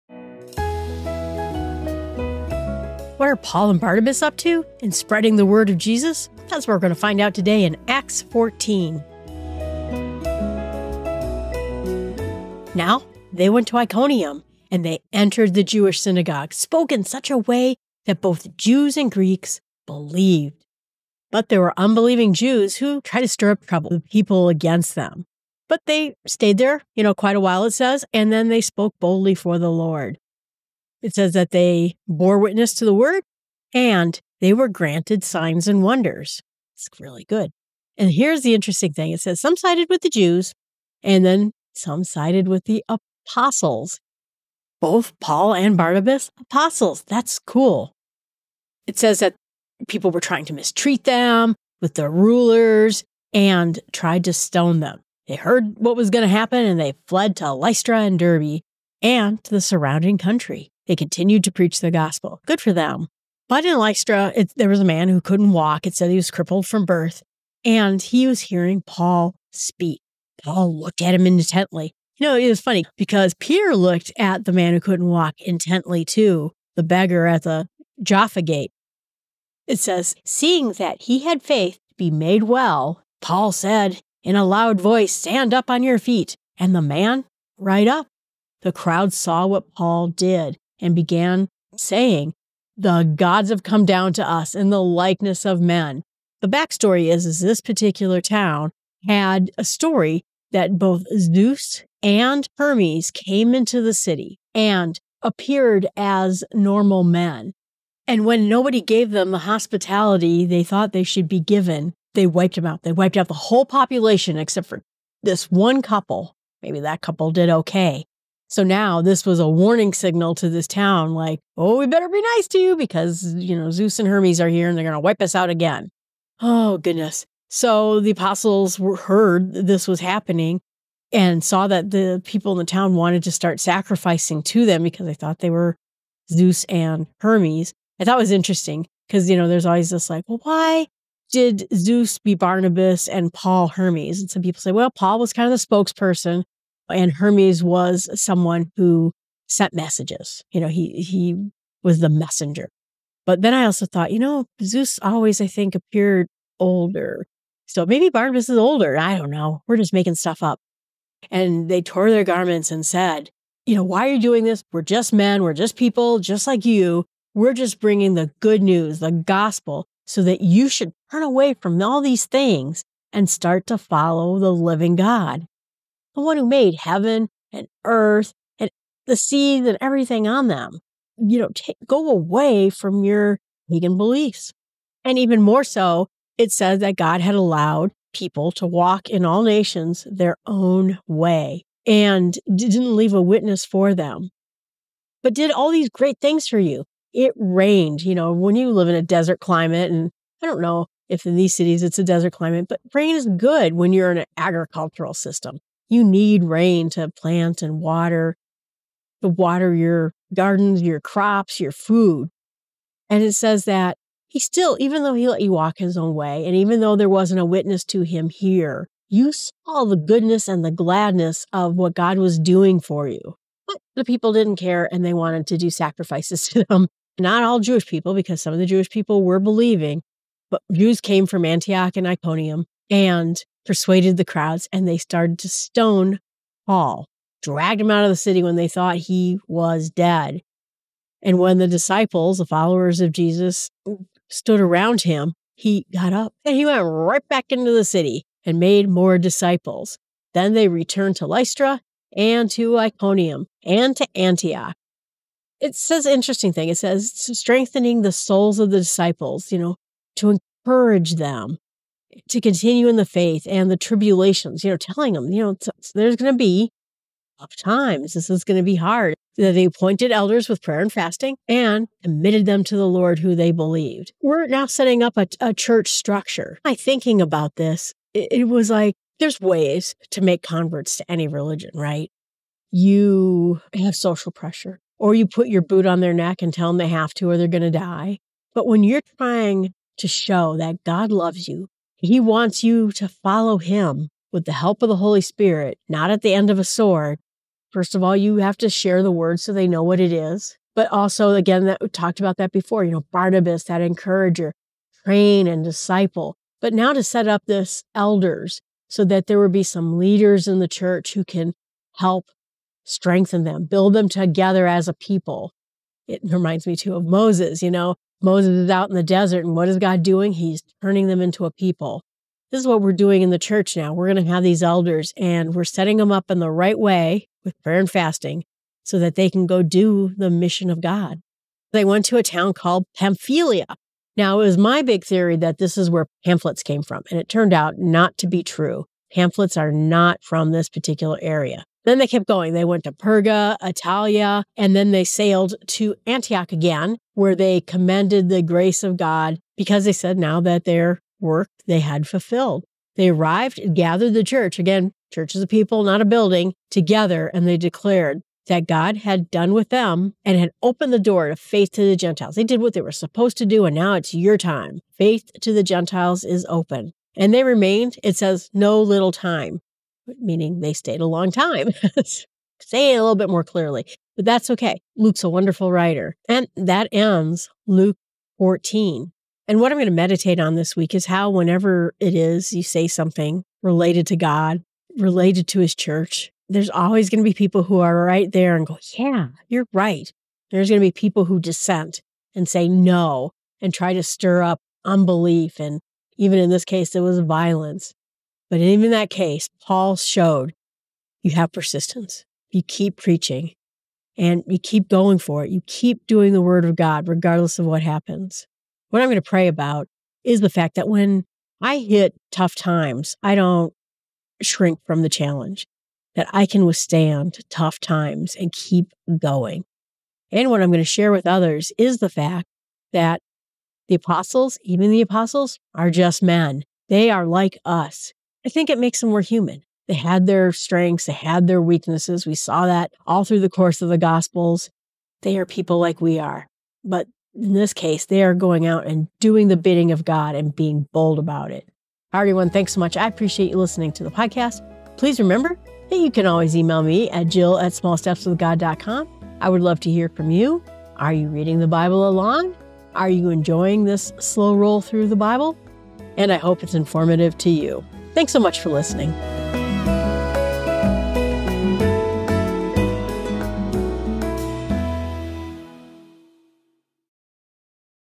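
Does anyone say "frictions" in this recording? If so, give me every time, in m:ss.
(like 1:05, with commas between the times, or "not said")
not said.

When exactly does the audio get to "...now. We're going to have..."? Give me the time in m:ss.
5:23.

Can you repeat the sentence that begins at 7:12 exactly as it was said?
We saw that all through the course of the Gospels.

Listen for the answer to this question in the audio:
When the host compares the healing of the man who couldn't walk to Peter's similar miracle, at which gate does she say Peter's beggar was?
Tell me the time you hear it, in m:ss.
1:18.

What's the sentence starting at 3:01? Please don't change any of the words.
You know, go away from your pagan beliefs.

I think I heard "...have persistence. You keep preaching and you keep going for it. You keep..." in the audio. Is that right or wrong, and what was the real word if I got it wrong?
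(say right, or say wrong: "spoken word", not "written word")
right.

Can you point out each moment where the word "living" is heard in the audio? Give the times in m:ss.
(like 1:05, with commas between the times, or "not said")
2:54.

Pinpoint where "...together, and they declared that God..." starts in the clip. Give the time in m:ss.
5:56.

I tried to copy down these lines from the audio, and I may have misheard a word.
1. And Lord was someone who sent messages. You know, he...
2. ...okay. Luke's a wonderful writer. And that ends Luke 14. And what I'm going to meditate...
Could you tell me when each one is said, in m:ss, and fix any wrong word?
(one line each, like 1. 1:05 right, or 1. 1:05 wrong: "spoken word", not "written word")
1. 2:26 wrong: "Hermes", not "Lord"
2. 6:14 right.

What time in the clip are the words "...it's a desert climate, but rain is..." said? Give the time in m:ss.
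3:21.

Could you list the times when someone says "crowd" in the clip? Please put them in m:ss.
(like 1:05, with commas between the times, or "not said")
1:28, 3:54.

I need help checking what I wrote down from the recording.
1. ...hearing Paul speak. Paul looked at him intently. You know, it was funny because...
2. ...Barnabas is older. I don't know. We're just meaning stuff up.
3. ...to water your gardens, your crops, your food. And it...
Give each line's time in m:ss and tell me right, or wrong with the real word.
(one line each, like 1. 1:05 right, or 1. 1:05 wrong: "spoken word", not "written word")
1. 1:08 right
2. 2:38 wrong: "making", not "meaning"
3. 3:29 right.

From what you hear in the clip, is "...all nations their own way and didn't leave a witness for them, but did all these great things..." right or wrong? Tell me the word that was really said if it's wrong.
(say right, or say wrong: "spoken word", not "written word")
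right.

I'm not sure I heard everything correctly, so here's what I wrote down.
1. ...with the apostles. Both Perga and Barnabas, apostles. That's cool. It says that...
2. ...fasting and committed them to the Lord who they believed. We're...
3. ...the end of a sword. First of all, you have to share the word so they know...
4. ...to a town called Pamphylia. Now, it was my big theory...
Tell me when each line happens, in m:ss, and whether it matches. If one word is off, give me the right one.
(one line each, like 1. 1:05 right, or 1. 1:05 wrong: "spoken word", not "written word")
1. 0:42 wrong: "Paul", not "Perga"
2. 4:30 right
3. 4:56 right
4. 5:32 right.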